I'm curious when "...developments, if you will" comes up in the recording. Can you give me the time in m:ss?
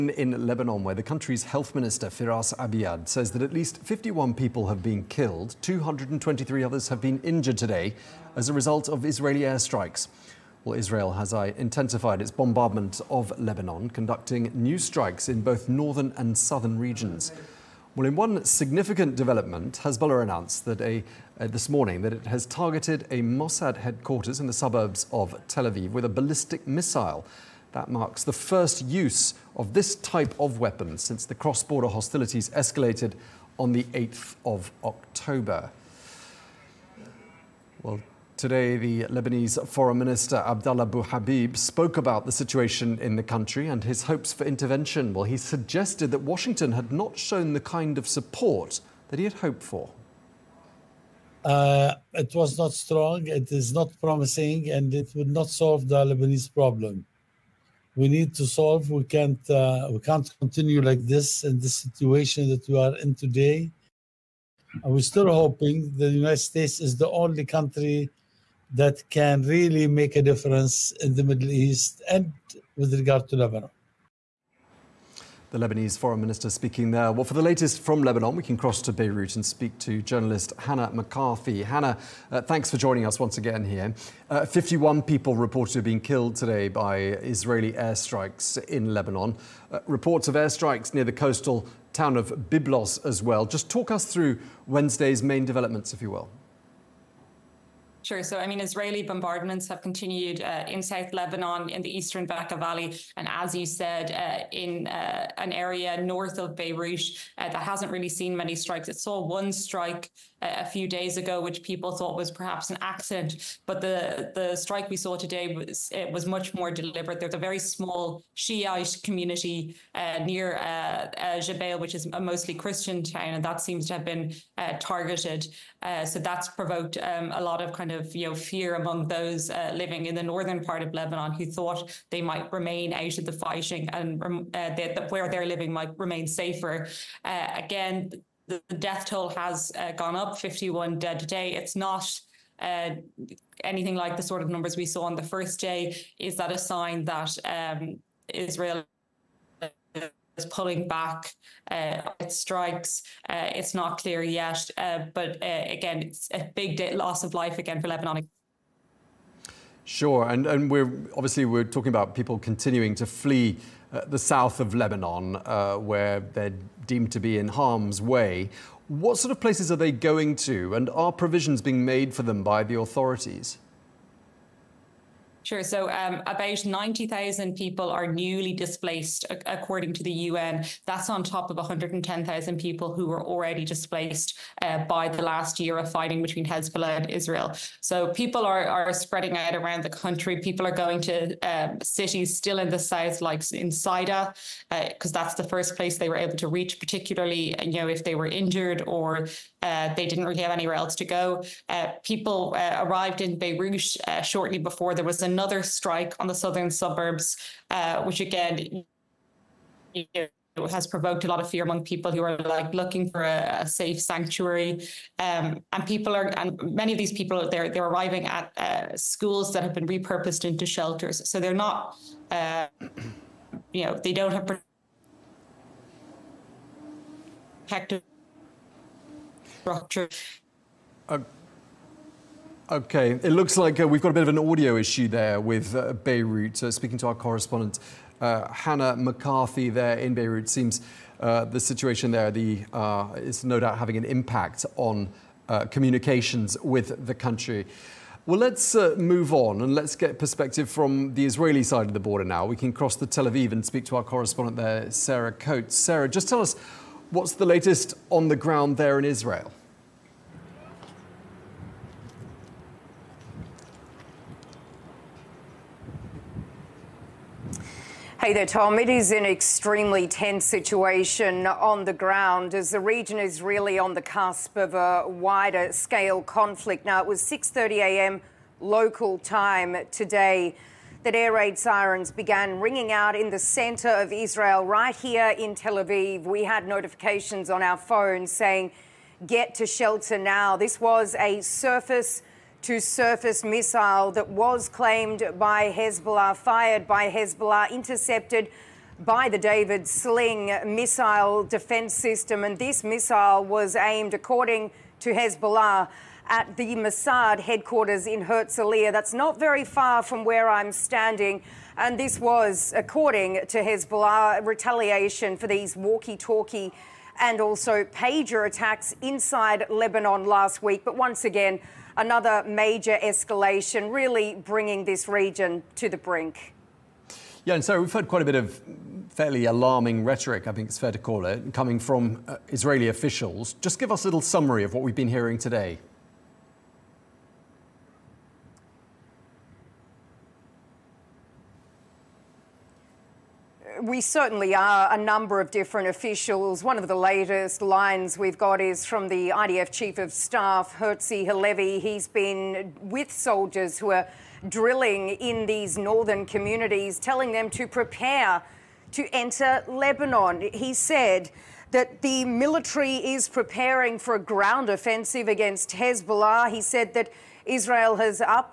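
1:35.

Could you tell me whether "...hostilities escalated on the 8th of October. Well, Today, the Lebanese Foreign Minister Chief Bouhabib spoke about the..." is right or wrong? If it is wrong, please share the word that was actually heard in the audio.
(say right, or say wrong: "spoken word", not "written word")
wrong: "Abdallah", not "Chief".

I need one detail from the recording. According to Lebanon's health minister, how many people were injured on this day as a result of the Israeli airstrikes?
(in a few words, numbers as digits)
223.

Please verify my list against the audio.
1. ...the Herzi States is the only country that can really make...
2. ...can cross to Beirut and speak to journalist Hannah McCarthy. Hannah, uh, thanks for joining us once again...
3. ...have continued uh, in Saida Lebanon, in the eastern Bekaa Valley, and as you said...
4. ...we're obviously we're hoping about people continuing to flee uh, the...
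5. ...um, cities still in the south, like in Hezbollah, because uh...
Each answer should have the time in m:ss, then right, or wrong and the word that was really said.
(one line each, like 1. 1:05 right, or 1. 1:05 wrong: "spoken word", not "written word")
1. 1:06 wrong: "United", not "Herzi"
2. 1:18 right
3. 1:39 wrong: "South", not "Saida"
4. 2:40 wrong: "talking", not "hoping"
5. 3:11 wrong: "Saida", not "Hezbollah".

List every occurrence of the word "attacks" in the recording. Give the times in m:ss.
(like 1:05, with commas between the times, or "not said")
5:18.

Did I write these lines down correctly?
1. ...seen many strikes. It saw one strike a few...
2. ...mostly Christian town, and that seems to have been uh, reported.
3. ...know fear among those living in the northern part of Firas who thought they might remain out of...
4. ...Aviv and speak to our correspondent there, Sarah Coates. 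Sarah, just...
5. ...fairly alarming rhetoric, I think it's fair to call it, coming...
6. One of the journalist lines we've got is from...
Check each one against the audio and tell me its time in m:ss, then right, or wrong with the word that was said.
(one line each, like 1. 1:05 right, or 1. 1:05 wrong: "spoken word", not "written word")
1. 1:48 right
2. 2:02 wrong: "targeted", not "reported"
3. 2:08 wrong: "Lebanon", not "Firas"
4. 4:13 right
5. 5:29 right
6. 5:46 wrong: "latest", not "journalist".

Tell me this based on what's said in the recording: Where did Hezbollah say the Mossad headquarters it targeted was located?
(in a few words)
Herzliya.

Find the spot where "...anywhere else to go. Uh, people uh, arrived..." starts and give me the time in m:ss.
3:20.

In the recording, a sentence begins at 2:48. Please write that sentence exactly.
What sort of places are they going to, and are provisions being made for them by the authorities?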